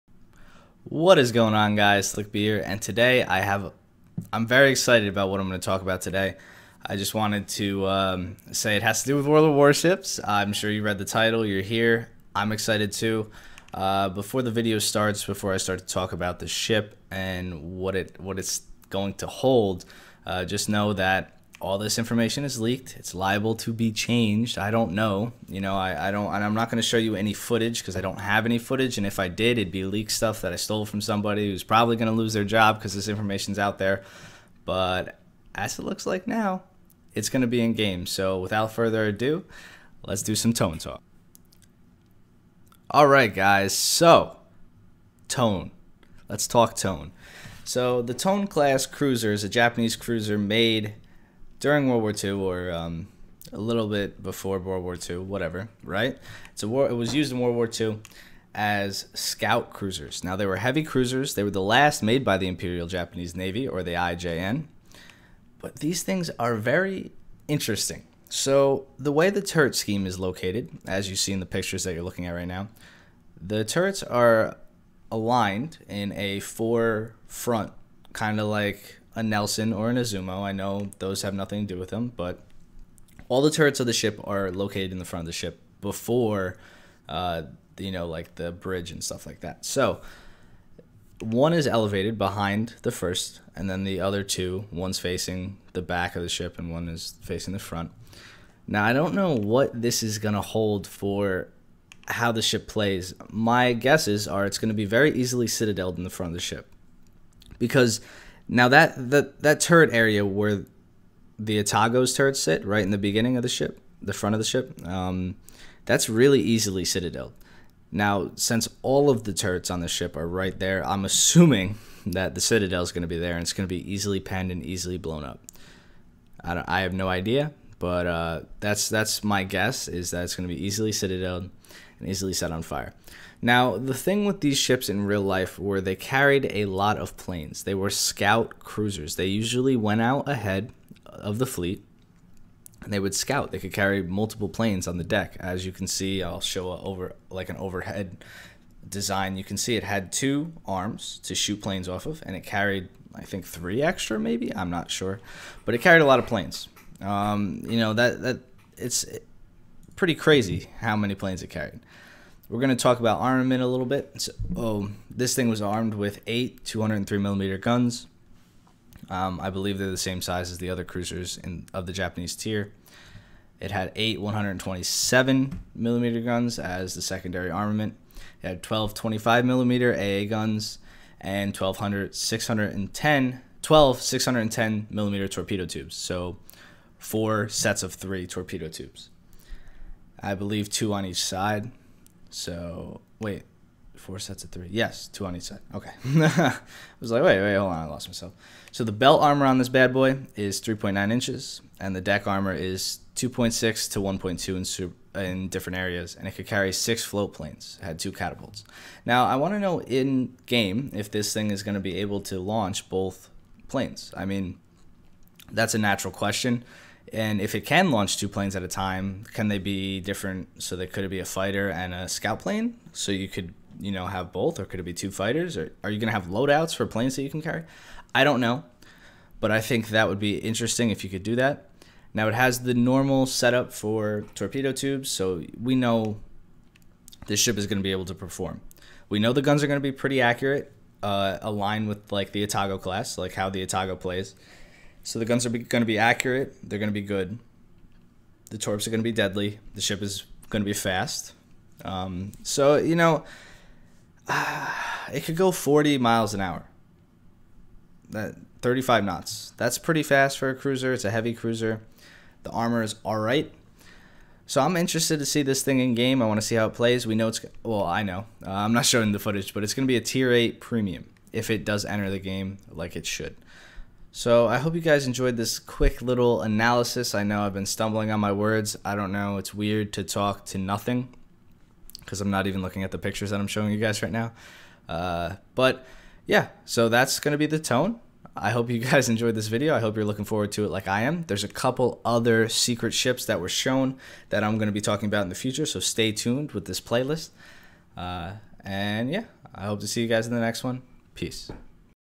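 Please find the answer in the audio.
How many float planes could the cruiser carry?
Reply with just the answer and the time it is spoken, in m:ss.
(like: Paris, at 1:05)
6, at 3:26.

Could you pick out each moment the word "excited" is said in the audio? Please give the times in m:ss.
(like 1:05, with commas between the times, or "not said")
0:04, 0:12.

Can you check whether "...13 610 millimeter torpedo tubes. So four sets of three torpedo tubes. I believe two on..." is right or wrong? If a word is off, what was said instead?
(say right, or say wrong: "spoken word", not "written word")
wrong: "12", not "13".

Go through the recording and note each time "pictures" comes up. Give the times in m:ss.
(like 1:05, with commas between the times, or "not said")
1:11, 4:42.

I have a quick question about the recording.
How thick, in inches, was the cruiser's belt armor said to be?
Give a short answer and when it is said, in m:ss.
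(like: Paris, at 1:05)
3.9 inches, at 3:20.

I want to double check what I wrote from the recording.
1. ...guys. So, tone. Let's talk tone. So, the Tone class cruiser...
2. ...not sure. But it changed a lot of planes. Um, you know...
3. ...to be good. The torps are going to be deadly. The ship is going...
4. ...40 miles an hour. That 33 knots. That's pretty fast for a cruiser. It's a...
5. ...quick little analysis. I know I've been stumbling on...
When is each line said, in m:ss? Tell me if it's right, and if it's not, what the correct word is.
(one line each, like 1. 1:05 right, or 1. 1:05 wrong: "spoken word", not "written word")
1. 0:43 right
2. 2:34 wrong: "carried", not "changed"
3. 4:06 right
4. 4:15 wrong: "35", not "33"
5. 4:35 right.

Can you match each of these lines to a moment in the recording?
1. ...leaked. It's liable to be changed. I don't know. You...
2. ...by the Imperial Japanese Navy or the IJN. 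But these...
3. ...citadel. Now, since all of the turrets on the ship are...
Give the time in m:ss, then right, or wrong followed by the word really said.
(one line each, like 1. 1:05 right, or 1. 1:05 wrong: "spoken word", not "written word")
1. 0:22 right
2. 1:02 right
3. 1:56 right.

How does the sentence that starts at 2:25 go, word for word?
As you can see, I'll show over like an overhead design.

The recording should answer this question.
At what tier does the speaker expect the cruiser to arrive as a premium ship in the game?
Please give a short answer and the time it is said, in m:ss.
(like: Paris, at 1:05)
tier 8, at 4:30.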